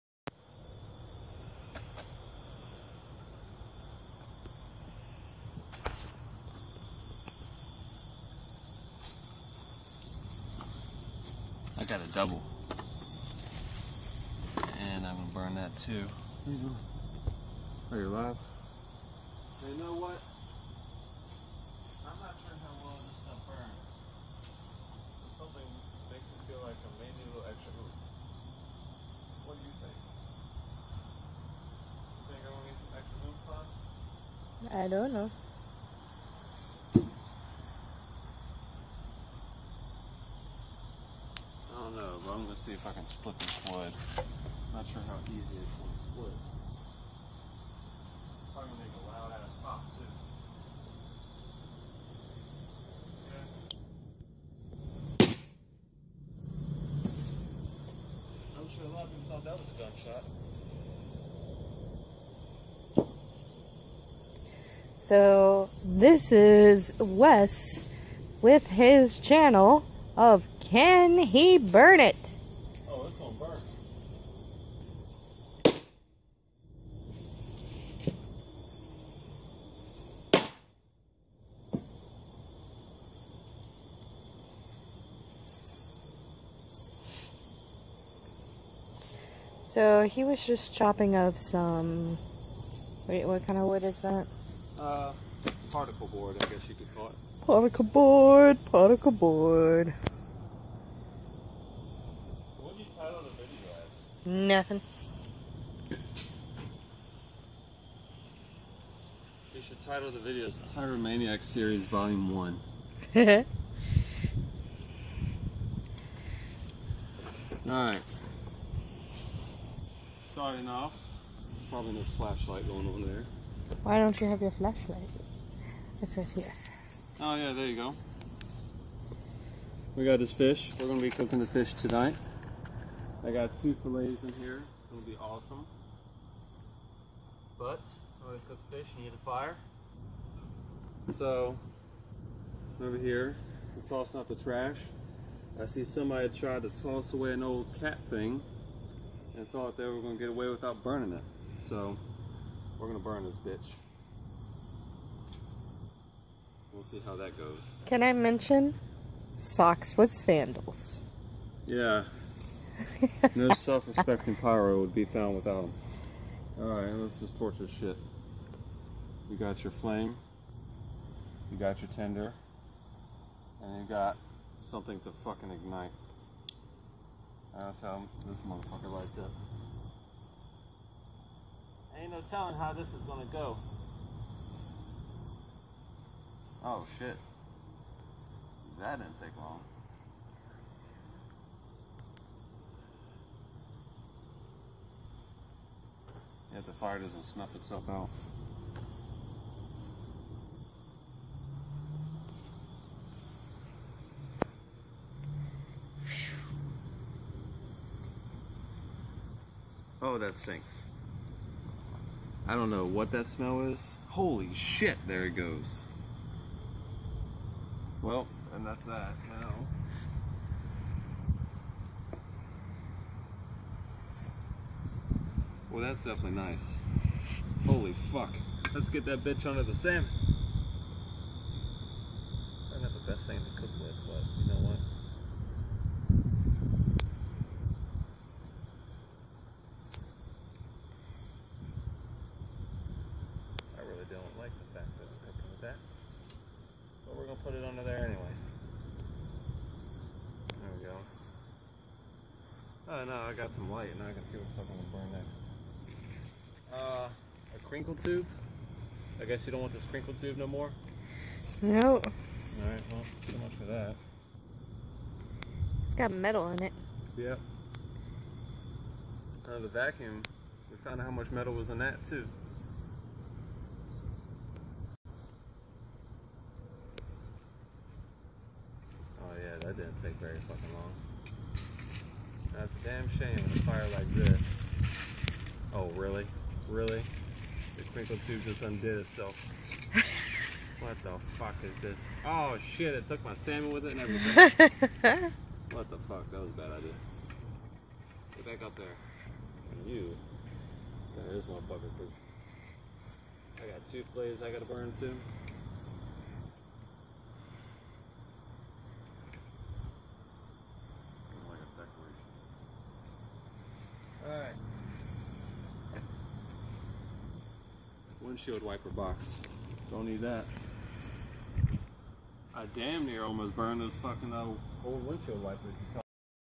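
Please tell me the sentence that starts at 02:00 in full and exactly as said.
Starting off, probably no flashlight going on there.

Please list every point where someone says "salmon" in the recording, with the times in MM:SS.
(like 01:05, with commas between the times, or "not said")
03:49, 04:53.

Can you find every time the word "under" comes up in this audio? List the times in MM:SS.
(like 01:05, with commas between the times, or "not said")
03:49, 04:07.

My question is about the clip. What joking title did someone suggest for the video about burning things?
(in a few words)
Pyromaniac Series Volume 1.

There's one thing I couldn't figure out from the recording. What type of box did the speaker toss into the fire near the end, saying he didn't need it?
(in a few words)
Windshield wiper box.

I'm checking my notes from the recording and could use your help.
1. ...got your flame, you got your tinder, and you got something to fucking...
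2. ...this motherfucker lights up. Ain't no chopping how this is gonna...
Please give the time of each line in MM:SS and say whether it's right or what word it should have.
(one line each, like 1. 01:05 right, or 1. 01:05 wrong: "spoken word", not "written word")
1. 02:49 right
2. 02:58 wrong: "telling", not "chopping".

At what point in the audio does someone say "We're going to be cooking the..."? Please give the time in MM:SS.
02:10.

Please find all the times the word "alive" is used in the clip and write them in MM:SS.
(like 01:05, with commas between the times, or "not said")
00:18.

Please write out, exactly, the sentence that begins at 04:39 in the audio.
Oh yeah, that didn't take very fucking long.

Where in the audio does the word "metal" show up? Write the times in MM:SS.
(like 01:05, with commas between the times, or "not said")
04:26, 04:31.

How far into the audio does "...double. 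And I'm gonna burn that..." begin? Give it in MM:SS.
00:12.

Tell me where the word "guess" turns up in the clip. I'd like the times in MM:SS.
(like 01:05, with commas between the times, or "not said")
01:36, 04:19.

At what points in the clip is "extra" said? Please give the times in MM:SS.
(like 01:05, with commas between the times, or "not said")
00:27, 00:32.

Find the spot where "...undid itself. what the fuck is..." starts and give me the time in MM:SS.
04:48.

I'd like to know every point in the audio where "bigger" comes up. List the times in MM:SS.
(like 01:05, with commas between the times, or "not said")
not said.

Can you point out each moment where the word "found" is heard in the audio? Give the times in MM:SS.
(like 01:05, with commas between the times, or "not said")
02:45, 04:30.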